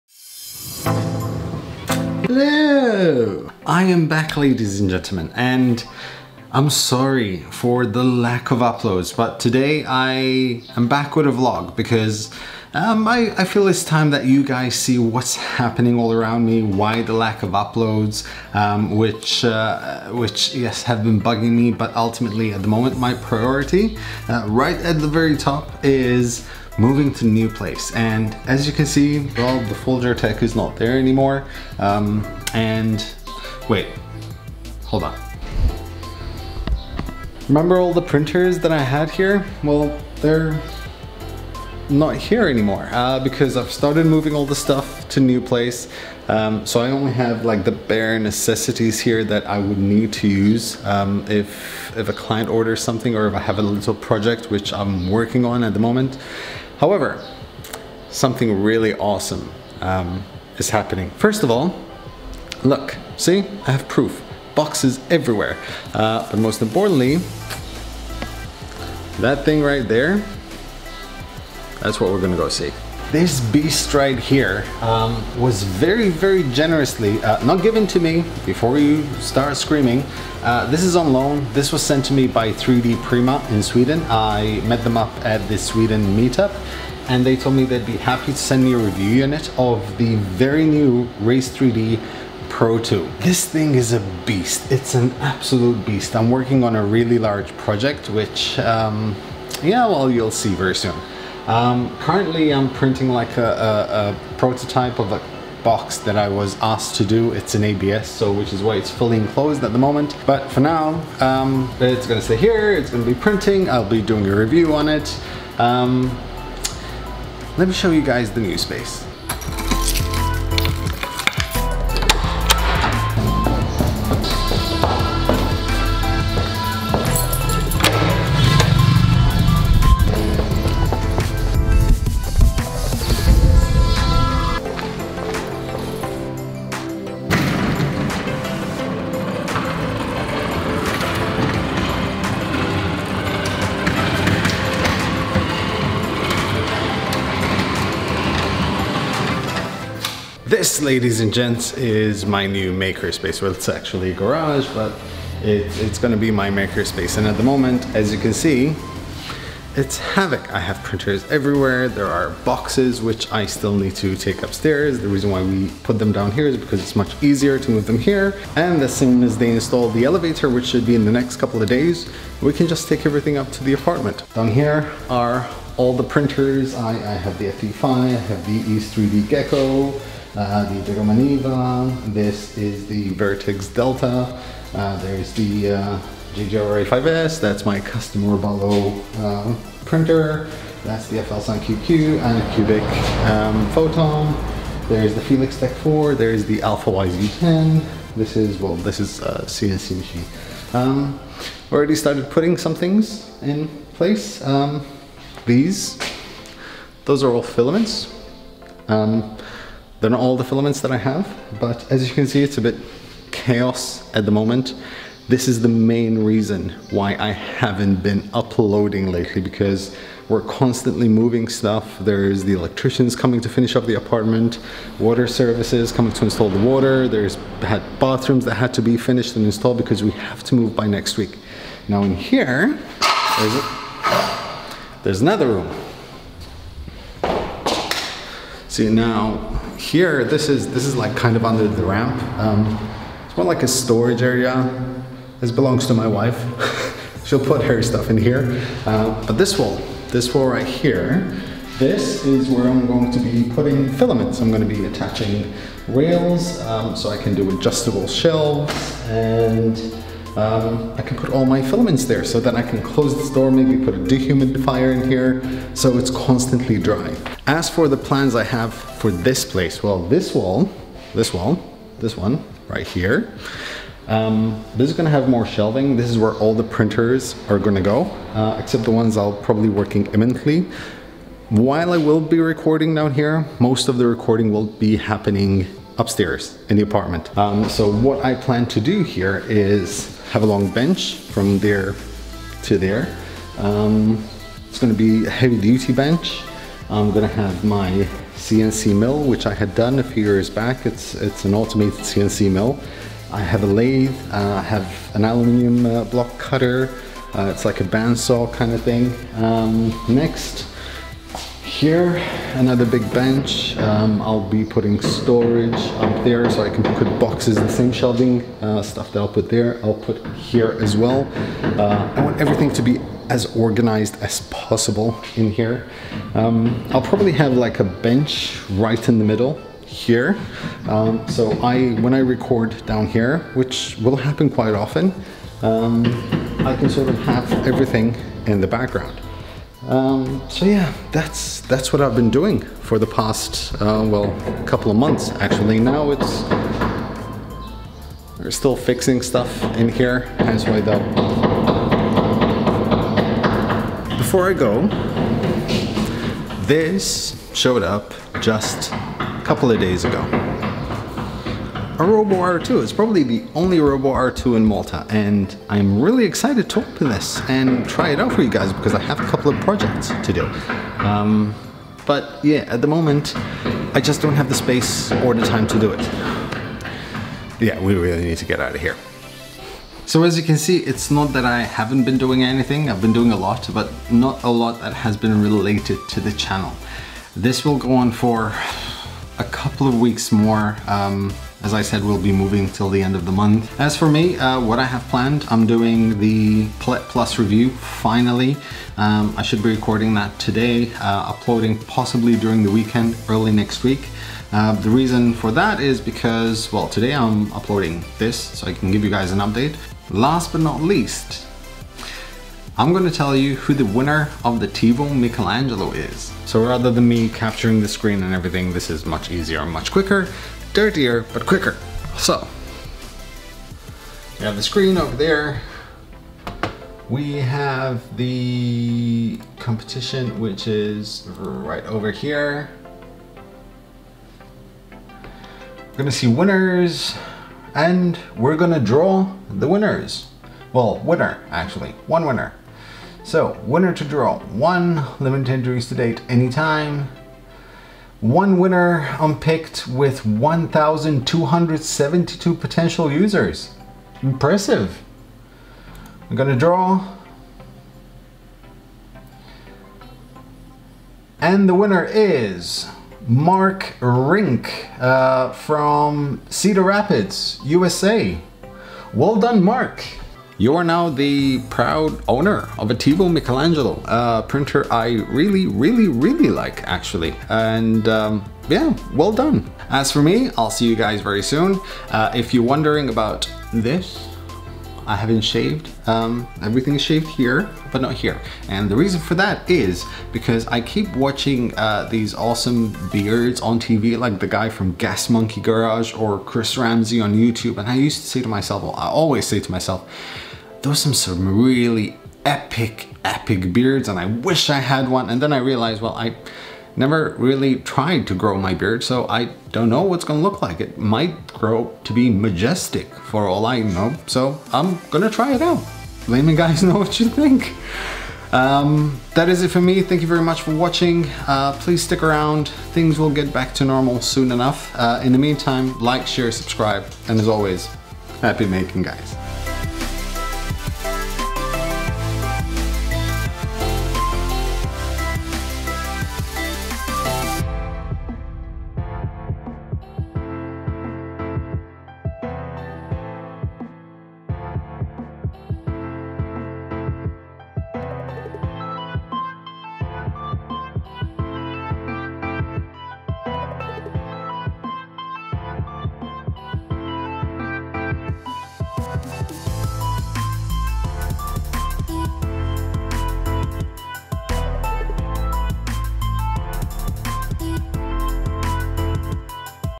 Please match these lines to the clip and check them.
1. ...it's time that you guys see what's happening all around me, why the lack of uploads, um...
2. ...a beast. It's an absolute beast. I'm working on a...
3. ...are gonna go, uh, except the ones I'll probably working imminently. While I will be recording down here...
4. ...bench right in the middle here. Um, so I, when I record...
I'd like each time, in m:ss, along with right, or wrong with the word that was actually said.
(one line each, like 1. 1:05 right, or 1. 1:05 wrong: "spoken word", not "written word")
1. 0:13 right
2. 1:33 right
3. 4:37 right
4. 5:27 right.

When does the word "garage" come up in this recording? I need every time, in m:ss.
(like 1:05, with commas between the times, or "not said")
2:34, 8:15.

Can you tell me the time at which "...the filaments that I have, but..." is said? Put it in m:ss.
3:30.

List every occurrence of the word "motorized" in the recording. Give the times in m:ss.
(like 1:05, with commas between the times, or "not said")
not said.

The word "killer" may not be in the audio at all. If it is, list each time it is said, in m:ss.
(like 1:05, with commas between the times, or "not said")
not said.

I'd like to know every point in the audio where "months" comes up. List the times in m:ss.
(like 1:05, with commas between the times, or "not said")
5:44, 6:33.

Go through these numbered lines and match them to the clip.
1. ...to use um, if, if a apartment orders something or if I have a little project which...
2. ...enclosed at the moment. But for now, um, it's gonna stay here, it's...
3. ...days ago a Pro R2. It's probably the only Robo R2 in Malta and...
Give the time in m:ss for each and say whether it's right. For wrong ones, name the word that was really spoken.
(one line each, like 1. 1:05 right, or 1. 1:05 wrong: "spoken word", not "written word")
1. 0:50 wrong: "client", not "apartment"
2. 1:49 right
3. 5:59 wrong: "Robo", not "Pro".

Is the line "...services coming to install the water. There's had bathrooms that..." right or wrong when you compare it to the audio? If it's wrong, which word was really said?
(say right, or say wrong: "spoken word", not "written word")
right.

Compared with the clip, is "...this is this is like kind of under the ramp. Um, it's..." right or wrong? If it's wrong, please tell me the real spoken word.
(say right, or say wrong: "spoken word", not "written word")
right.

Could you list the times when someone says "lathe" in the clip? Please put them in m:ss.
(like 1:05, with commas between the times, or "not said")
5:03.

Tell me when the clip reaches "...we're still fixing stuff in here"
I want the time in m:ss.
5:48.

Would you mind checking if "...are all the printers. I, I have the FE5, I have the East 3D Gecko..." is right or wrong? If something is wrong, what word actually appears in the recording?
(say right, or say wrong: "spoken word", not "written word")
right.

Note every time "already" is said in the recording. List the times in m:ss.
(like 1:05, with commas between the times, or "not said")
3:21.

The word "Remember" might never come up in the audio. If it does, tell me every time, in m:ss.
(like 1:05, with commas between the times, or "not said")
0:37.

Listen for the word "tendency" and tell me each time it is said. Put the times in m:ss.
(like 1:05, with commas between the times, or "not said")
not said.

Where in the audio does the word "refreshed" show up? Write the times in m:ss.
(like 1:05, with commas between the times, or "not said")
not said.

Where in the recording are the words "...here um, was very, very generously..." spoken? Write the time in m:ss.
1:14.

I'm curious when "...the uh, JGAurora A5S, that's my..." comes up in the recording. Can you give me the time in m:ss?
3:05.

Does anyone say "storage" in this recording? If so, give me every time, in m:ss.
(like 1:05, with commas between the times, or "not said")
4:03, 5:15.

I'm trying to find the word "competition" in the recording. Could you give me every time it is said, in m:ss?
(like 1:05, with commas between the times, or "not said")
7:09.